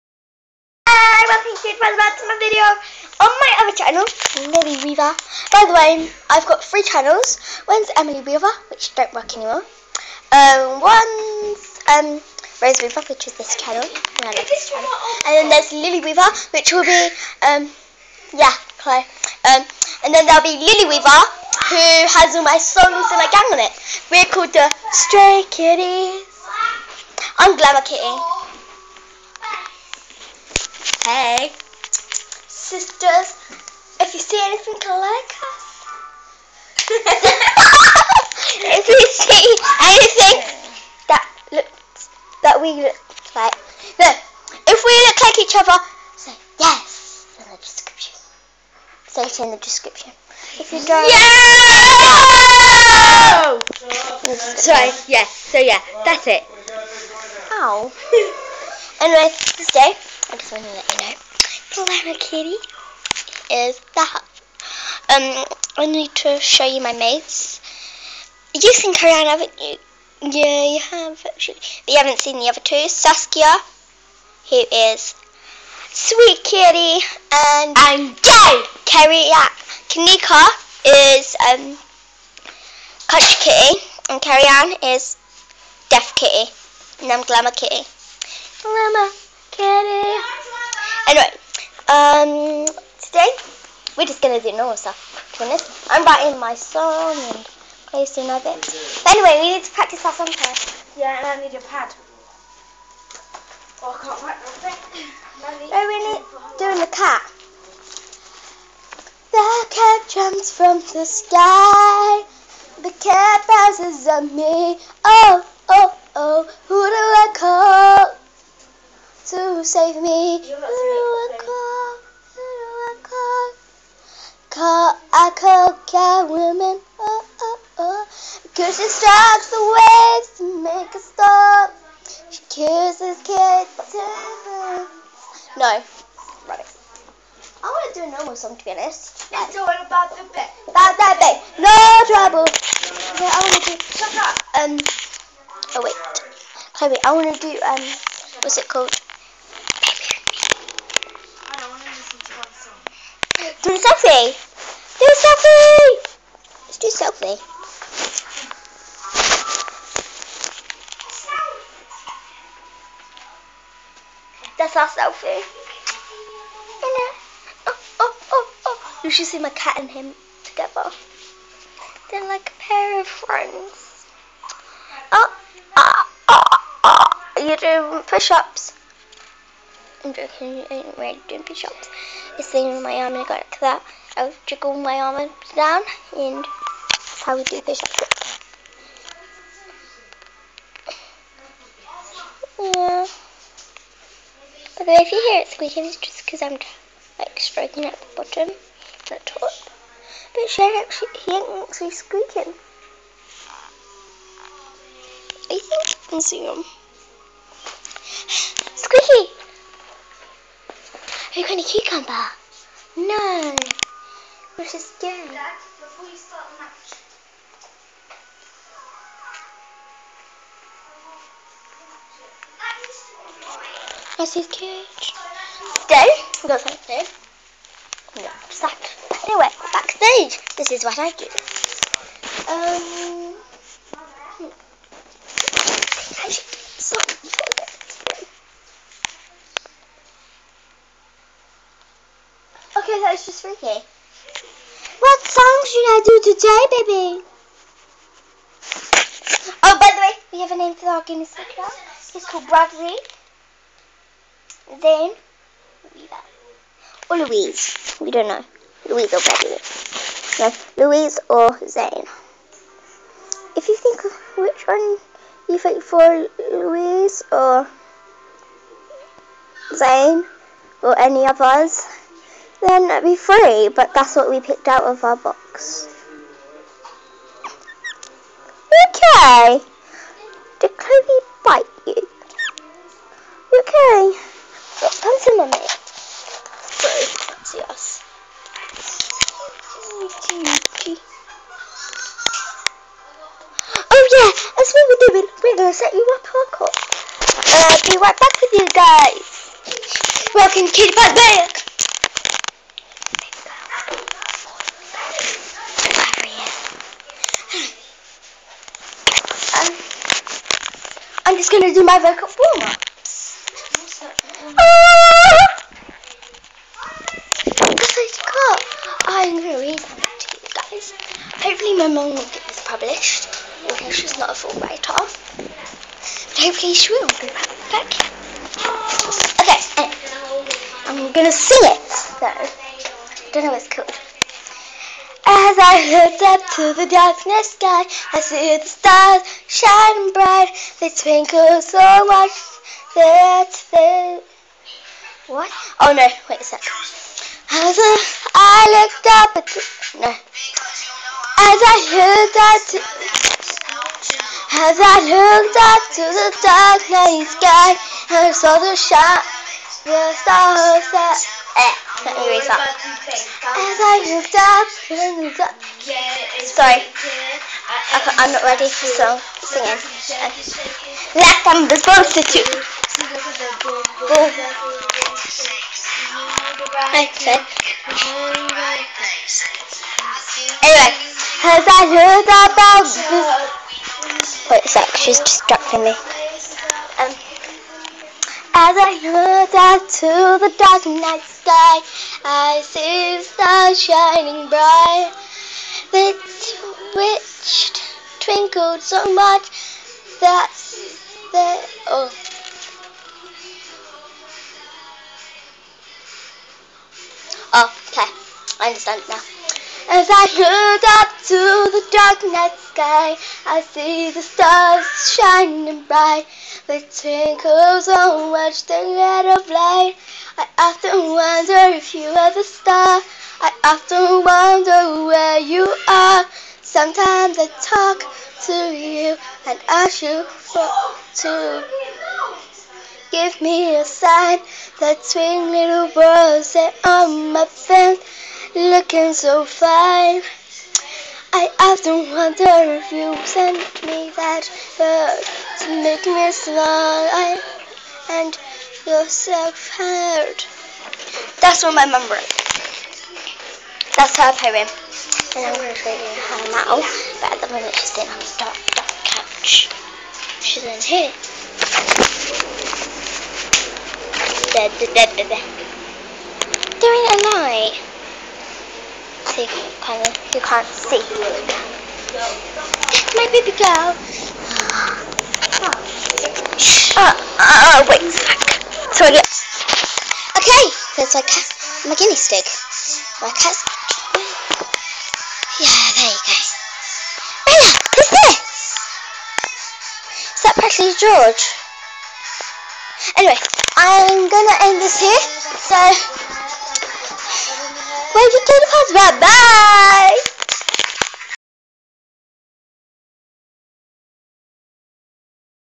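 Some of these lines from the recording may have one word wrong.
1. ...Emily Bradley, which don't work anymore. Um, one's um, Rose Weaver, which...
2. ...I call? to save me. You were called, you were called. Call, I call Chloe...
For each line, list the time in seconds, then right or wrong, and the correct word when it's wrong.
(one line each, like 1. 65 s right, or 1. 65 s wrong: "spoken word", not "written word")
1. 7 s wrong: "Weaver", not "Bradley"
2. 117 s wrong: "God", not "Chloe".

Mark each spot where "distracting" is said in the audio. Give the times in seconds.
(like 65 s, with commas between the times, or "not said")
385 s.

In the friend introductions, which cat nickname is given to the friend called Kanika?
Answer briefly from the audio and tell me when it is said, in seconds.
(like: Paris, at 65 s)
Country Kitty, at 83 s.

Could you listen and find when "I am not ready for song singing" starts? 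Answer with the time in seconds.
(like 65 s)
367 s.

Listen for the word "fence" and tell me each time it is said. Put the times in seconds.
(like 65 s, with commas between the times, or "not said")
437 s.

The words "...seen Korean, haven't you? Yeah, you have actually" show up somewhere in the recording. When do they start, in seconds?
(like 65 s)
68 s.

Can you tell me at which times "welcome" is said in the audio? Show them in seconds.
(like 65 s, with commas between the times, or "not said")
1 s, 300 s.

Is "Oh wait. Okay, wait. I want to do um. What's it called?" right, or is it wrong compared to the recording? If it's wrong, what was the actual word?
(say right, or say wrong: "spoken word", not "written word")
right.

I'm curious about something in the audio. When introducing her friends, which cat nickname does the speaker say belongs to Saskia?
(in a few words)
Sweet Kitty.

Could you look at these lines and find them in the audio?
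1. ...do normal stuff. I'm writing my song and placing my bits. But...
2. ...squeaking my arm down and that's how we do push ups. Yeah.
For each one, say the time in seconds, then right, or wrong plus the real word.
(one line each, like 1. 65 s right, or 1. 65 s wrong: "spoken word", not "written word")
1. 94 s right
2. 184 s wrong: "jiggling", not "squeaking".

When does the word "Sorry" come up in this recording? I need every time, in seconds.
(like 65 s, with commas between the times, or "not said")
54 s, 286 s, 366 s.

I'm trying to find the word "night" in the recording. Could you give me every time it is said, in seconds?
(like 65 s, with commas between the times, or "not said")
356 s, 390 s, 412 s, 467 s.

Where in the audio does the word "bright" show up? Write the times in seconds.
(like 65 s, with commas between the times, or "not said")
340 s, 394 s, 415 s.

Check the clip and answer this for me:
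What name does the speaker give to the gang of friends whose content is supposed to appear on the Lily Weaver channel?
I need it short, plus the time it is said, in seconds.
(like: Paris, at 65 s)
Stray Kitties, at 24 s.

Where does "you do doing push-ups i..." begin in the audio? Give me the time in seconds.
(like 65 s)
177 s.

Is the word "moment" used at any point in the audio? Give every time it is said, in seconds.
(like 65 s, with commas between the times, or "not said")
457 s.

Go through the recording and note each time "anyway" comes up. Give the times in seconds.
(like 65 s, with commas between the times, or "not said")
59 s, 89 s, 99 s, 229 s, 380 s, 493 s.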